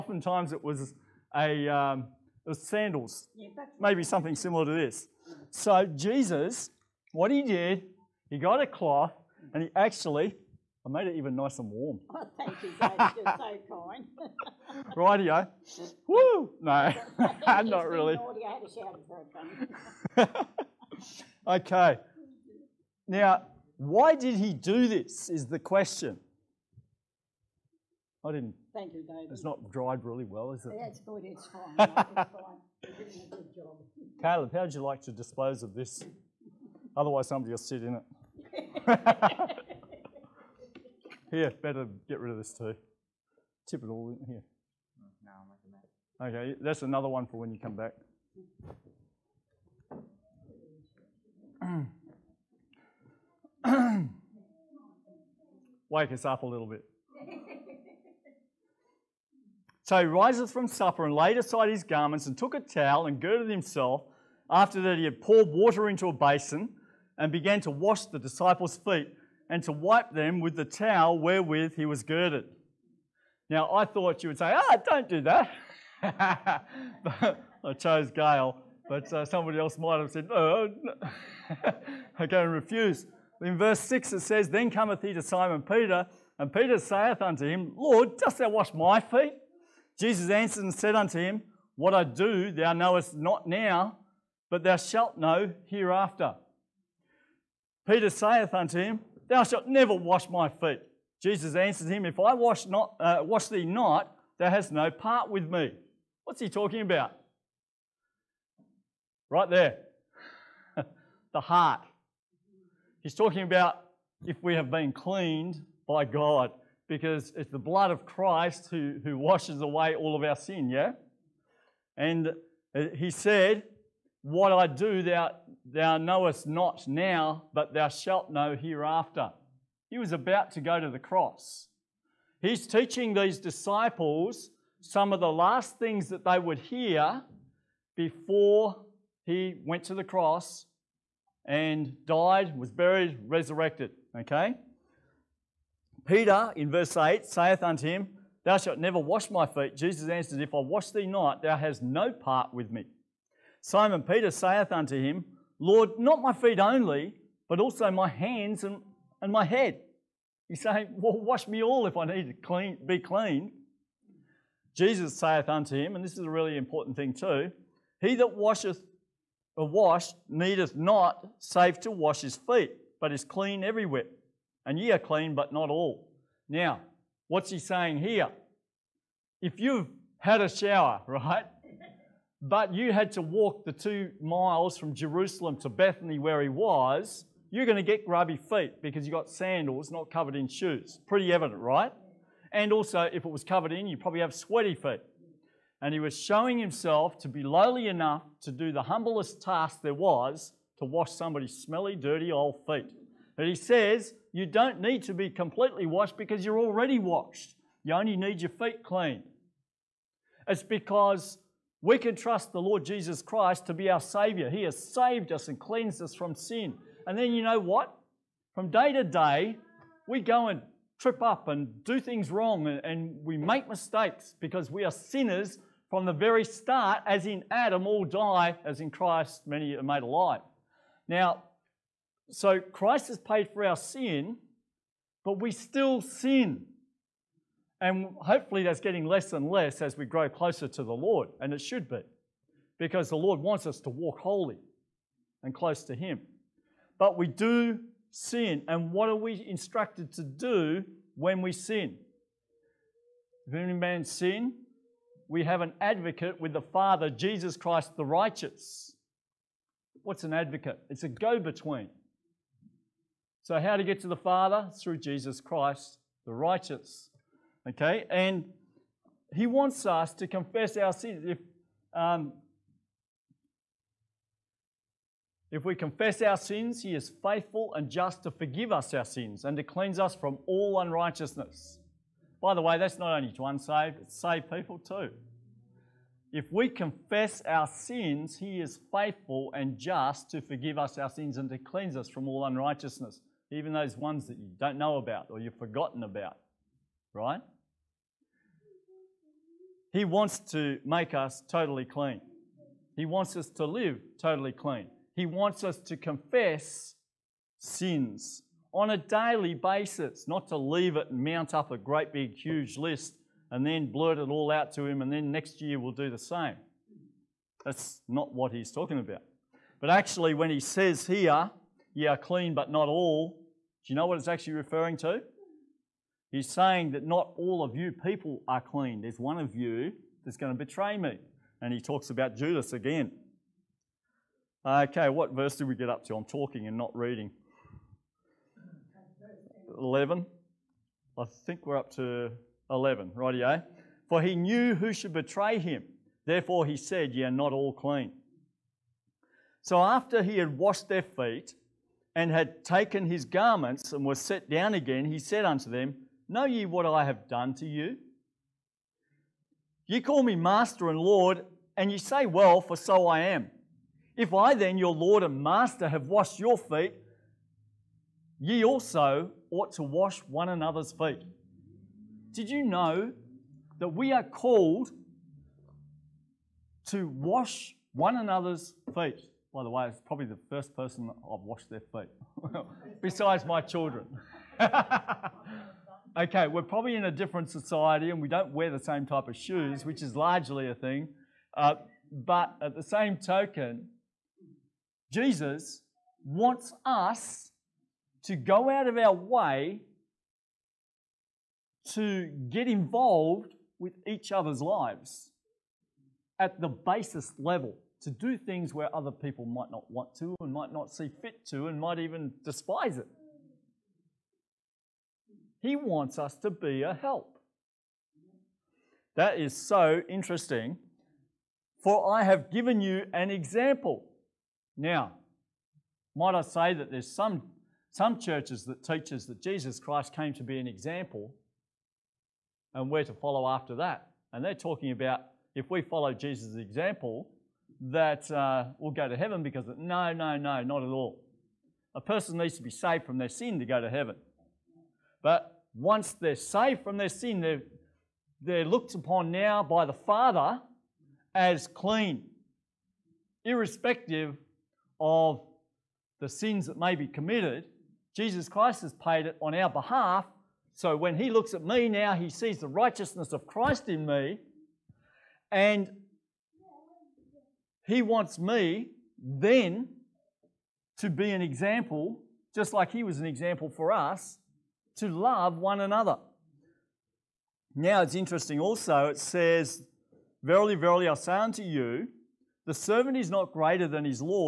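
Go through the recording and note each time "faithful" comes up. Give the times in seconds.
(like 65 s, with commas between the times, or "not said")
277 s, 288 s.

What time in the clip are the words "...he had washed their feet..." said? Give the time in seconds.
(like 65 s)
350 s.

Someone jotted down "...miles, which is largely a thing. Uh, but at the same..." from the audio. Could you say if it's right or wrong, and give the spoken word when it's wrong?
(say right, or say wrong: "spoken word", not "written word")
wrong: "shoes", not "miles".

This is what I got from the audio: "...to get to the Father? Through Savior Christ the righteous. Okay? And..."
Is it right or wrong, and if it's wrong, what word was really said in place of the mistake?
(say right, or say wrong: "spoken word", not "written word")
wrong: "Jesus", not "Savior".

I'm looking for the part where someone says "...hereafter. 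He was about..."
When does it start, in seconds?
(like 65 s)
128 s.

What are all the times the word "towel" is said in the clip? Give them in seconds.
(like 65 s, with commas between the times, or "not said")
62 s, 70 s.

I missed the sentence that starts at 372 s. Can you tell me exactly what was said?
Did you know that we are called to wash one another's feet?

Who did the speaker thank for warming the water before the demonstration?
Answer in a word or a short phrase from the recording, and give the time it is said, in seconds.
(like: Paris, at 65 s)
Dave, at 12 s.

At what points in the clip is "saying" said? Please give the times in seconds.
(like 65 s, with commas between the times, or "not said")
160 s, 177 s, 326 s.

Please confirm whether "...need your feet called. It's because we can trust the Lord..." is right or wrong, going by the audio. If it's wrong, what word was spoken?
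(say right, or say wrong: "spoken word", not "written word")
wrong: "cleaned", not "called".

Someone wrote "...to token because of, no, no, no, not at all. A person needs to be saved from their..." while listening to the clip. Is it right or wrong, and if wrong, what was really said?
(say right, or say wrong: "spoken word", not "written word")
wrong: "heaven", not "token".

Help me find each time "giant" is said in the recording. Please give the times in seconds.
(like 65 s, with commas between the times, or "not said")
not said.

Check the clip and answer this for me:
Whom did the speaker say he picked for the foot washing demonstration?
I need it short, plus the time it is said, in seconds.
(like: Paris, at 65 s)
Gail, at 78 s.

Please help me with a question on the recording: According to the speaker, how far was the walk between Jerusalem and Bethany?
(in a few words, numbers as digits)
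2 miles.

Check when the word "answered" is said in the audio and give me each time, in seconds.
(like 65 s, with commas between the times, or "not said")
90 s, 101 s, 150 s.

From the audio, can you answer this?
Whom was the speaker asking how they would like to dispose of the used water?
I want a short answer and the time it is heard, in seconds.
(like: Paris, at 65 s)
Caleb, at 34 s.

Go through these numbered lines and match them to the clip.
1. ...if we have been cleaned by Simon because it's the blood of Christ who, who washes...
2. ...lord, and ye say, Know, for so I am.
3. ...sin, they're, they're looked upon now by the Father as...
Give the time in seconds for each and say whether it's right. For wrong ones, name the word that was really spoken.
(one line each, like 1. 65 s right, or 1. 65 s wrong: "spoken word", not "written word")
1. 114 s wrong: "God", not "Simon"
2. 360 s wrong: "Well", not "Know"
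3. 447 s right.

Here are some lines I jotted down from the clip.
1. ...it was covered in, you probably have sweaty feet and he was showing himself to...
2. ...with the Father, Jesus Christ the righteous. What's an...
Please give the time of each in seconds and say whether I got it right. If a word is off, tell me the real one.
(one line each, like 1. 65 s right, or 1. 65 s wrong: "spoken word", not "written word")
1. 193 s right
2. 256 s right.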